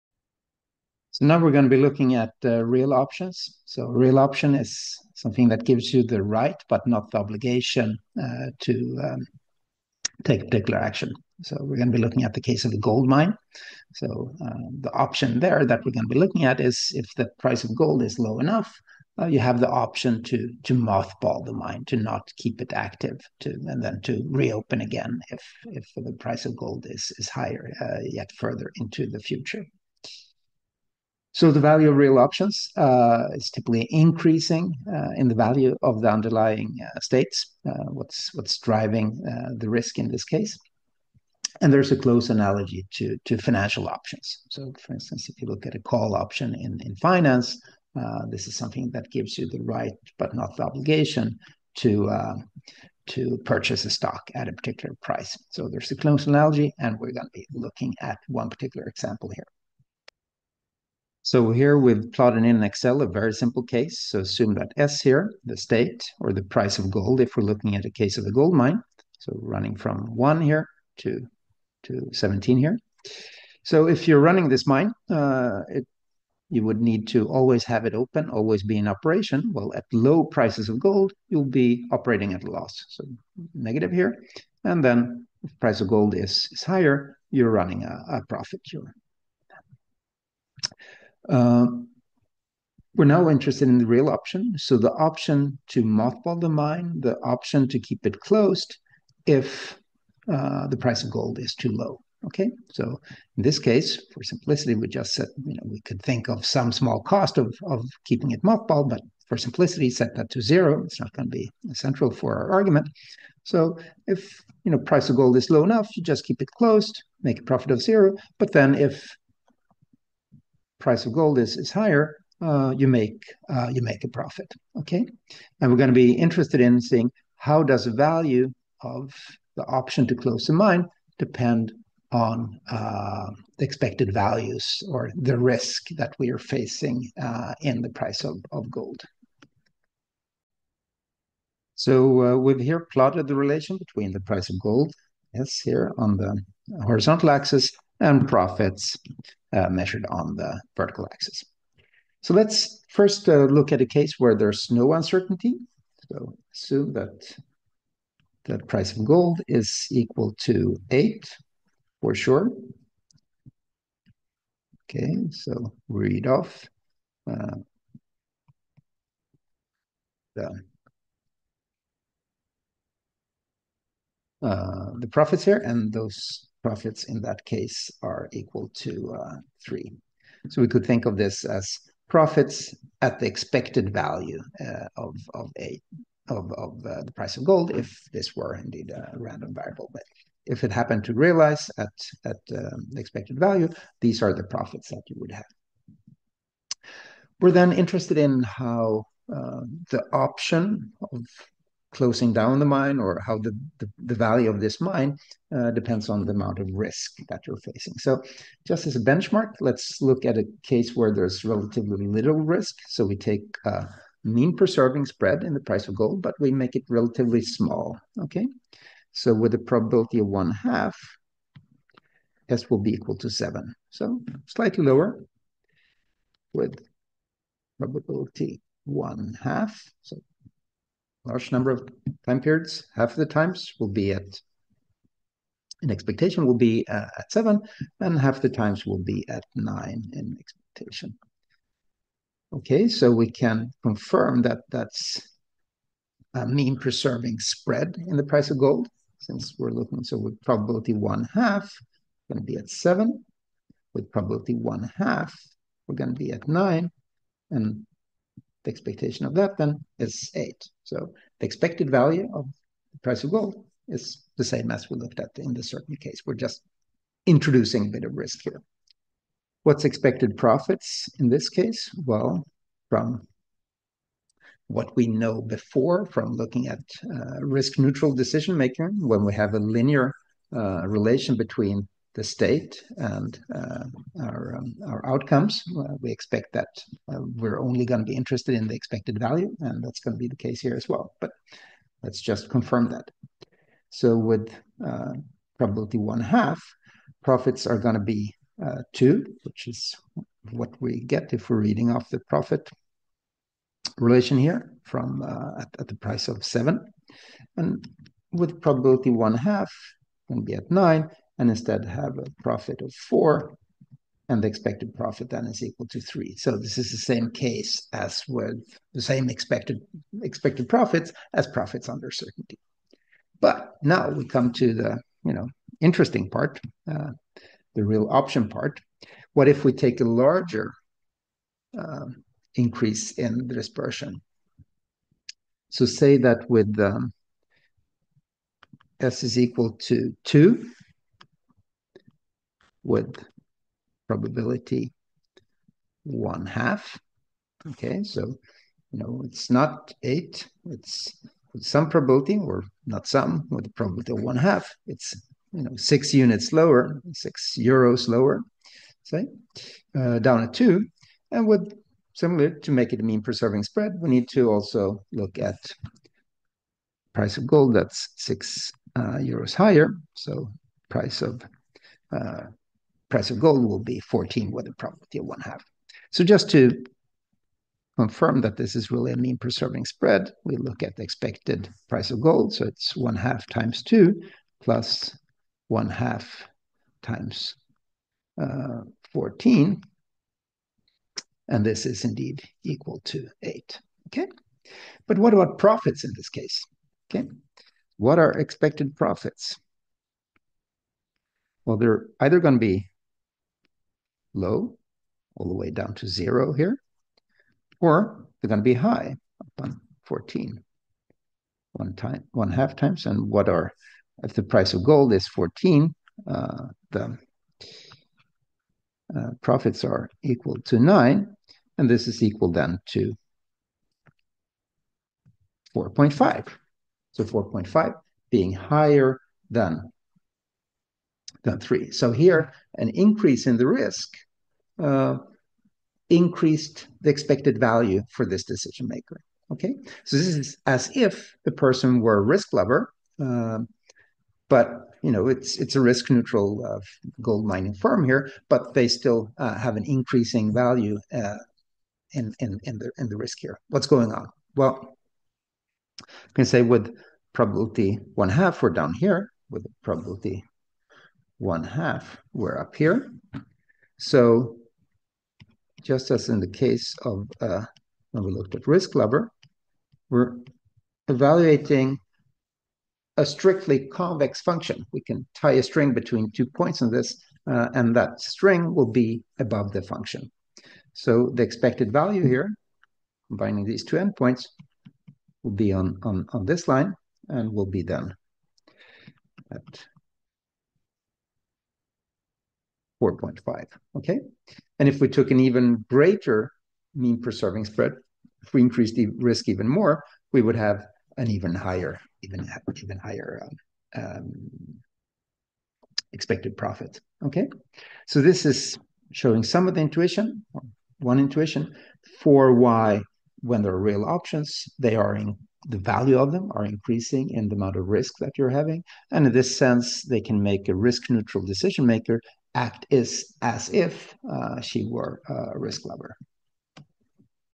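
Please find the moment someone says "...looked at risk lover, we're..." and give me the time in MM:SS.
07:48.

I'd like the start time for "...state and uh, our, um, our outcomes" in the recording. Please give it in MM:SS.
04:42.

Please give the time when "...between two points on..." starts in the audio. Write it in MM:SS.
07:55.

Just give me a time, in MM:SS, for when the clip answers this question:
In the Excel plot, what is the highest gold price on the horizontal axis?
01:12.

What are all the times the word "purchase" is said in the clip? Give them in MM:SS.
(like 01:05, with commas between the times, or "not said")
00:53.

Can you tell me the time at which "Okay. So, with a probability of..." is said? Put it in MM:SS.
03:38.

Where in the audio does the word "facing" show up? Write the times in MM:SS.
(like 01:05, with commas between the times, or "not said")
02:16, 03:27.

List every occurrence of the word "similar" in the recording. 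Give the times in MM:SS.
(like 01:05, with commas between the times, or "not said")
06:02.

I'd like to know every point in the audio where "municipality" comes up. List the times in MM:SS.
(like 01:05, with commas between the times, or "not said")
not said.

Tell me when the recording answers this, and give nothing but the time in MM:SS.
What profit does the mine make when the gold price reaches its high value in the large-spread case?
07:00.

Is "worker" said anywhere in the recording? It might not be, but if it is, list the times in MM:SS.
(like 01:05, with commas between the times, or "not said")
not said.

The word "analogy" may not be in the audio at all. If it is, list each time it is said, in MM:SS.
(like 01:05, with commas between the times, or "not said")
00:42, 00:56.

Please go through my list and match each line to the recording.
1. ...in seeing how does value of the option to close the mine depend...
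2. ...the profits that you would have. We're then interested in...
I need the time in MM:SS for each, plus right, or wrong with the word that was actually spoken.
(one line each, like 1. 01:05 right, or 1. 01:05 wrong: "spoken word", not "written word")
1. 02:06 right
2. 03:14 right.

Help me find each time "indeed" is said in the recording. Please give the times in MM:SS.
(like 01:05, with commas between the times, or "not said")
03:08, 06:32.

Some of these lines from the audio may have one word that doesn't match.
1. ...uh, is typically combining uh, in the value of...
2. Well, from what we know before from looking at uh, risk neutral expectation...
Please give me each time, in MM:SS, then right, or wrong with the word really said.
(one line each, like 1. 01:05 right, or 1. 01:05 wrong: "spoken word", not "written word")
1. 00:32 wrong: "increasing", not "combining"
2. 04:32 wrong: "decision", not "expectation".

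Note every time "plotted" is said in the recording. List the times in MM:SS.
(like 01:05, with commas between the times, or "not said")
01:02, 02:22.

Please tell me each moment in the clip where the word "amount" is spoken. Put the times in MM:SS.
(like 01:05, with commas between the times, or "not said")
03:26, 08:37.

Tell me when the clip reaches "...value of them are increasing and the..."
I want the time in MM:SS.
08:35.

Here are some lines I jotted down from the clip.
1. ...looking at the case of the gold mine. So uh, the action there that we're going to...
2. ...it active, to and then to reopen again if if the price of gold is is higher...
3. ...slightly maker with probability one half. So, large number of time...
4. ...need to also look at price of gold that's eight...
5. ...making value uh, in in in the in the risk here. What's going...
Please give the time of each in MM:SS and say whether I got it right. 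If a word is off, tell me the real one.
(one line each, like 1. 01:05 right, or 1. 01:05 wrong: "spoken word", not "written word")
1. 00:12 wrong: "option", not "action"
2. 00:22 right
3. 03:44 wrong: "lower", not "maker"
4. 06:04 wrong: "six", not "eight"
5. 07:29 wrong: "increasing", not "making".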